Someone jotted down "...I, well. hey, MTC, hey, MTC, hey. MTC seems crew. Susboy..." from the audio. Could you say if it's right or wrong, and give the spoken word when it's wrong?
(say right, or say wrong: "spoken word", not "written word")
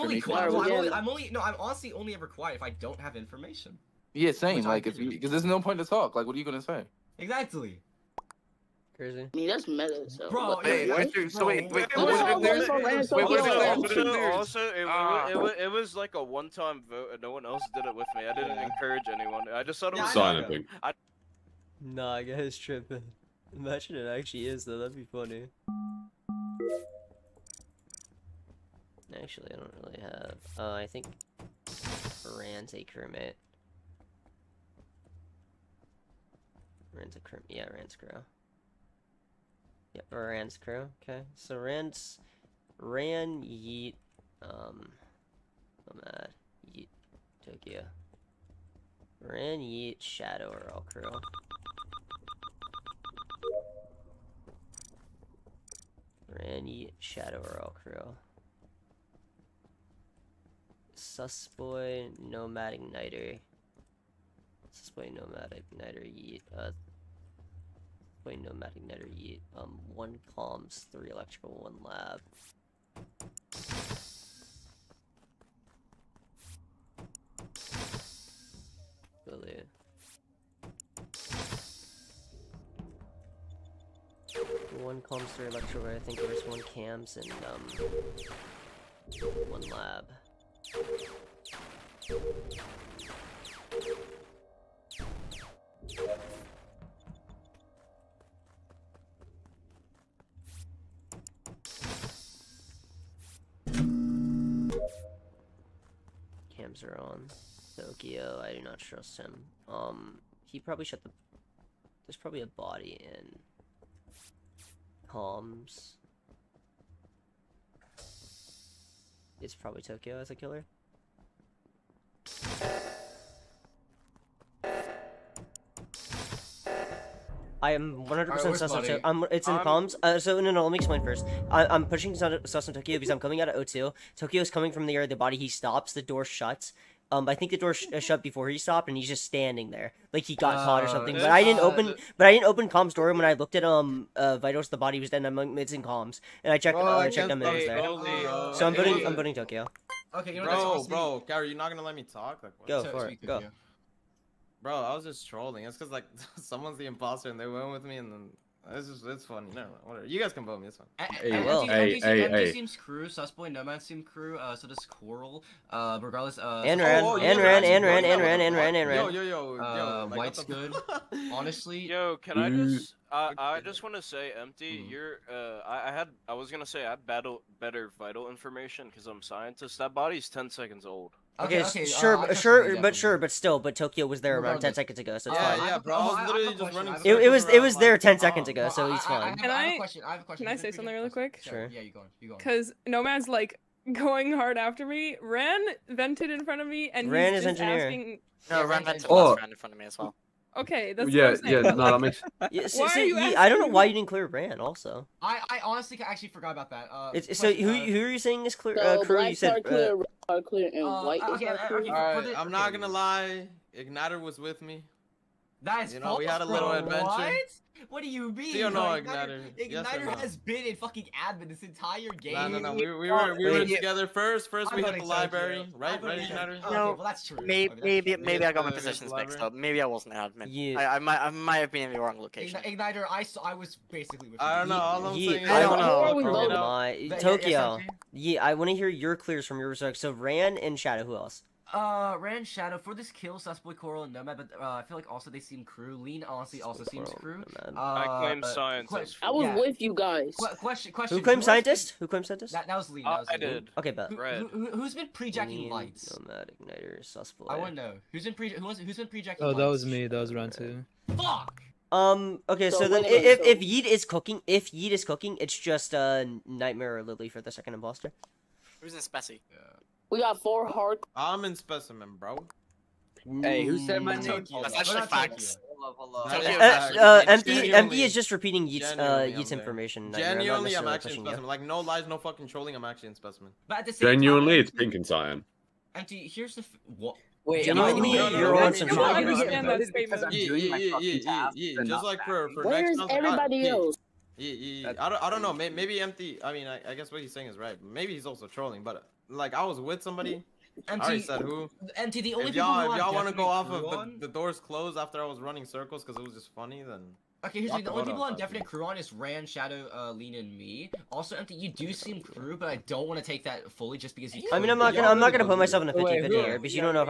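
right.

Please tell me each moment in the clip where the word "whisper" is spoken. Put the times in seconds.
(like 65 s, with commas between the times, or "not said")
not said.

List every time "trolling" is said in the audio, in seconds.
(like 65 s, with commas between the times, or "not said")
155 s, 282 s, 298 s.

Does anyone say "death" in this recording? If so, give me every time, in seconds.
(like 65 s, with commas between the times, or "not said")
not said.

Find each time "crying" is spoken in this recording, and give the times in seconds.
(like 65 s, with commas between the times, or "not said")
not said.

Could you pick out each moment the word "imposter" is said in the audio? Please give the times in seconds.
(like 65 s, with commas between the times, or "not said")
156 s, 267 s.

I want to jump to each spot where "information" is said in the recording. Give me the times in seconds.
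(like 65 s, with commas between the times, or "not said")
3 s, 178 s, 279 s.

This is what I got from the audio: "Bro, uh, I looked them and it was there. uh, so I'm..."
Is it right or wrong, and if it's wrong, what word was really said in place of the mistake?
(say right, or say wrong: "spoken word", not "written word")
wrong: "checked", not "looked".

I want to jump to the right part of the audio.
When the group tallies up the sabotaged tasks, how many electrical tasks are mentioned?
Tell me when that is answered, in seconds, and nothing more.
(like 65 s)
70 s.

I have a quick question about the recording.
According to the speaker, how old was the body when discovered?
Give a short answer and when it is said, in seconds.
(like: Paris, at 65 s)
10 seconds, at 180 s.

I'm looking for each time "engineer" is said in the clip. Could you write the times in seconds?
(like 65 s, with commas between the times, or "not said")
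197 s.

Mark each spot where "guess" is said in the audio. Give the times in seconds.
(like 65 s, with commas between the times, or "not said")
22 s, 296 s.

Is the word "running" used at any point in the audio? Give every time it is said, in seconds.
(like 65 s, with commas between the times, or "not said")
186 s, 305 s.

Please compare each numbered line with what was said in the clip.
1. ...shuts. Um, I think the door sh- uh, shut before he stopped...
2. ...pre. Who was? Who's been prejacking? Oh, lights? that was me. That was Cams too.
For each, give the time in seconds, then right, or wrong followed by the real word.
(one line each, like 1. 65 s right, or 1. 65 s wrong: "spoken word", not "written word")
1. 136 s right
2. 258 s wrong: "Ran", not "Cams".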